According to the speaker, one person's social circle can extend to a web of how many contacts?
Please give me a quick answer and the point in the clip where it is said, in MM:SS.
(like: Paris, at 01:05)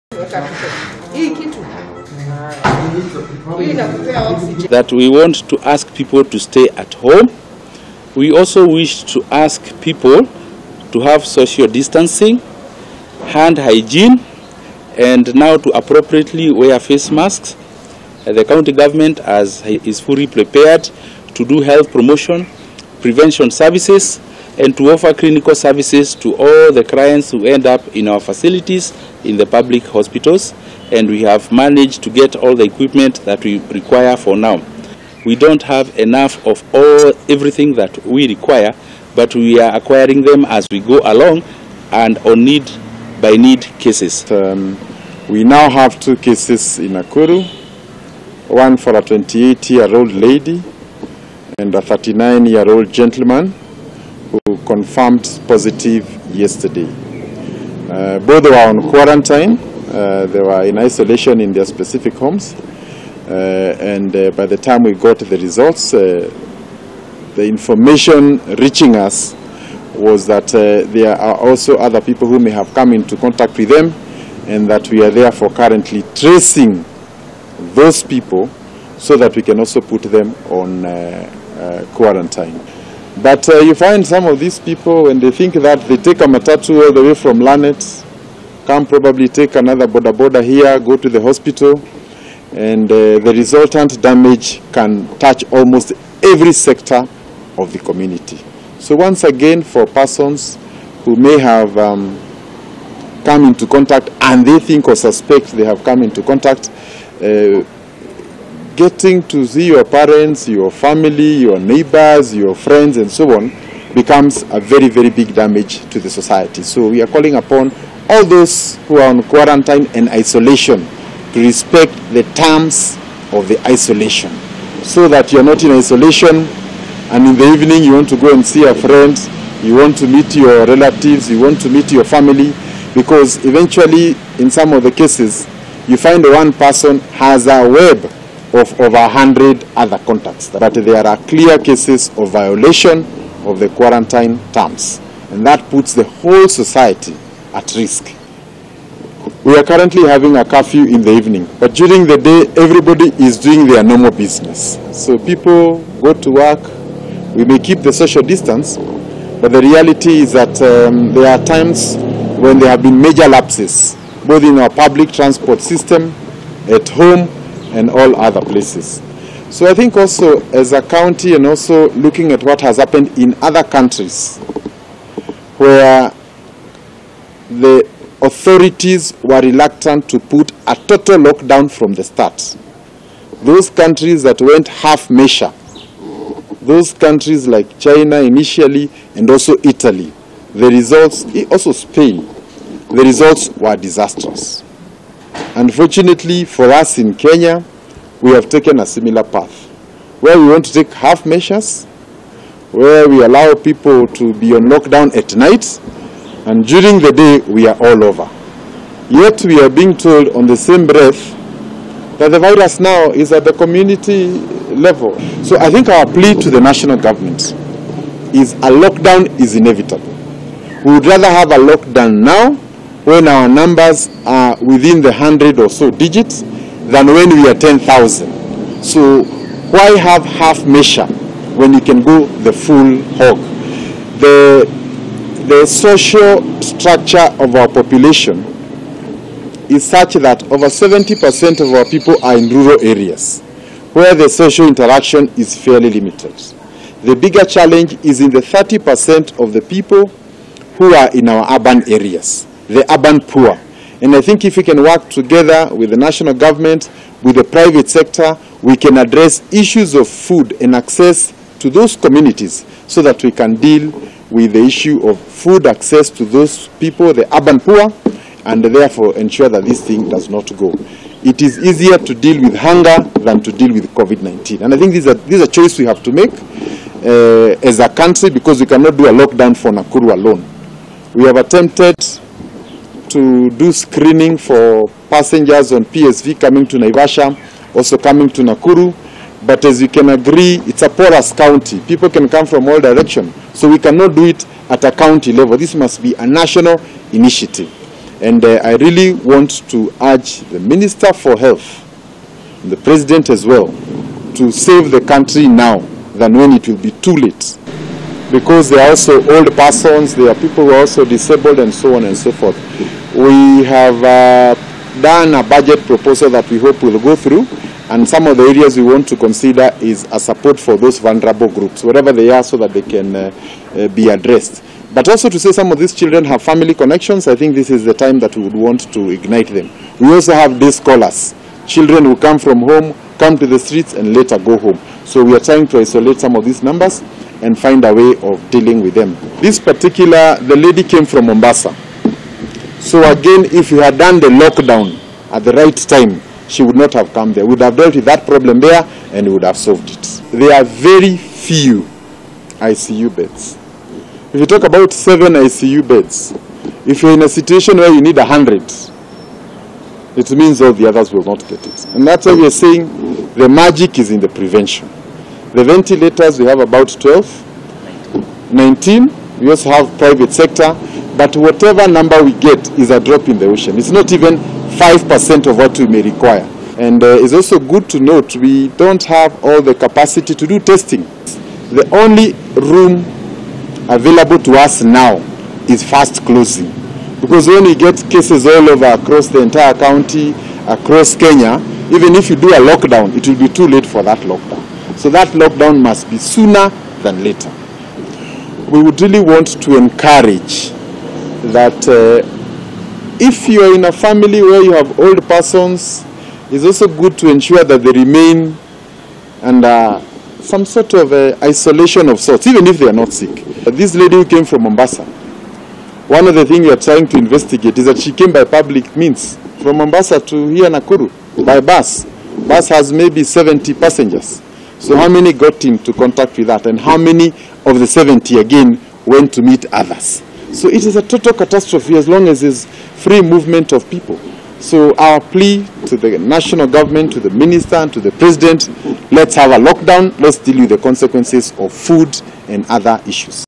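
over 100, at 02:18.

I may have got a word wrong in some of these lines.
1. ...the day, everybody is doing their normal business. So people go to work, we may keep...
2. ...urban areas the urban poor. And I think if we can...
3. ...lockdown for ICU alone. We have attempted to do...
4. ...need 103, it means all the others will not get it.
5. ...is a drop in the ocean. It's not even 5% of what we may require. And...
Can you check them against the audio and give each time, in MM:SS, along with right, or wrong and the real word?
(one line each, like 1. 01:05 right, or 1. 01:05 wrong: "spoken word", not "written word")
1. 02:32 right
2. 04:11 right
3. 04:39 wrong: "Nakuru", not "ICU"
4. 05:58 wrong: "100", not "103"
5. 06:12 right.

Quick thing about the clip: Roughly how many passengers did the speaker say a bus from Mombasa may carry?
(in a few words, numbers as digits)
70.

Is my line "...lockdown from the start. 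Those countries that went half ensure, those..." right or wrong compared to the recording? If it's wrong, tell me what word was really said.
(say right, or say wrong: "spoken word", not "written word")
wrong: "measure", not "ensure".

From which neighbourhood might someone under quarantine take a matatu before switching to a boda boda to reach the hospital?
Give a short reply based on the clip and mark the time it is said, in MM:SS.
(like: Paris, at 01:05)
Lanet, at 01:27.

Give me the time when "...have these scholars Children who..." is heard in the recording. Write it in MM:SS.
05:30.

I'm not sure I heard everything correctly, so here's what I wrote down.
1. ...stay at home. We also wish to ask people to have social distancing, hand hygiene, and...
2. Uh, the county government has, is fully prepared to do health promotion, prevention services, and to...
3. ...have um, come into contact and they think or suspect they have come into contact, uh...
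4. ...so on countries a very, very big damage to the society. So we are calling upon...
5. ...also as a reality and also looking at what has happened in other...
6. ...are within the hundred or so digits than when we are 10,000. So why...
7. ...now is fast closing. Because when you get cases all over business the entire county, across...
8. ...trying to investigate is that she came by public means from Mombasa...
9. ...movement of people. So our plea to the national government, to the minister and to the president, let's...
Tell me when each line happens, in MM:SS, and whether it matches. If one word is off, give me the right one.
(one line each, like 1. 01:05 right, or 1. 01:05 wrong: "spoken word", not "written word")
1. 00:06 right
2. 00:18 right
3. 01:41 right
4. 01:53 wrong: "becomes", not "countries"
5. 02:49 wrong: "county", not "reality"
6. 03:44 right
7. 06:24 wrong: "across", not "business"
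8. 06:56 right
9. 07:13 right.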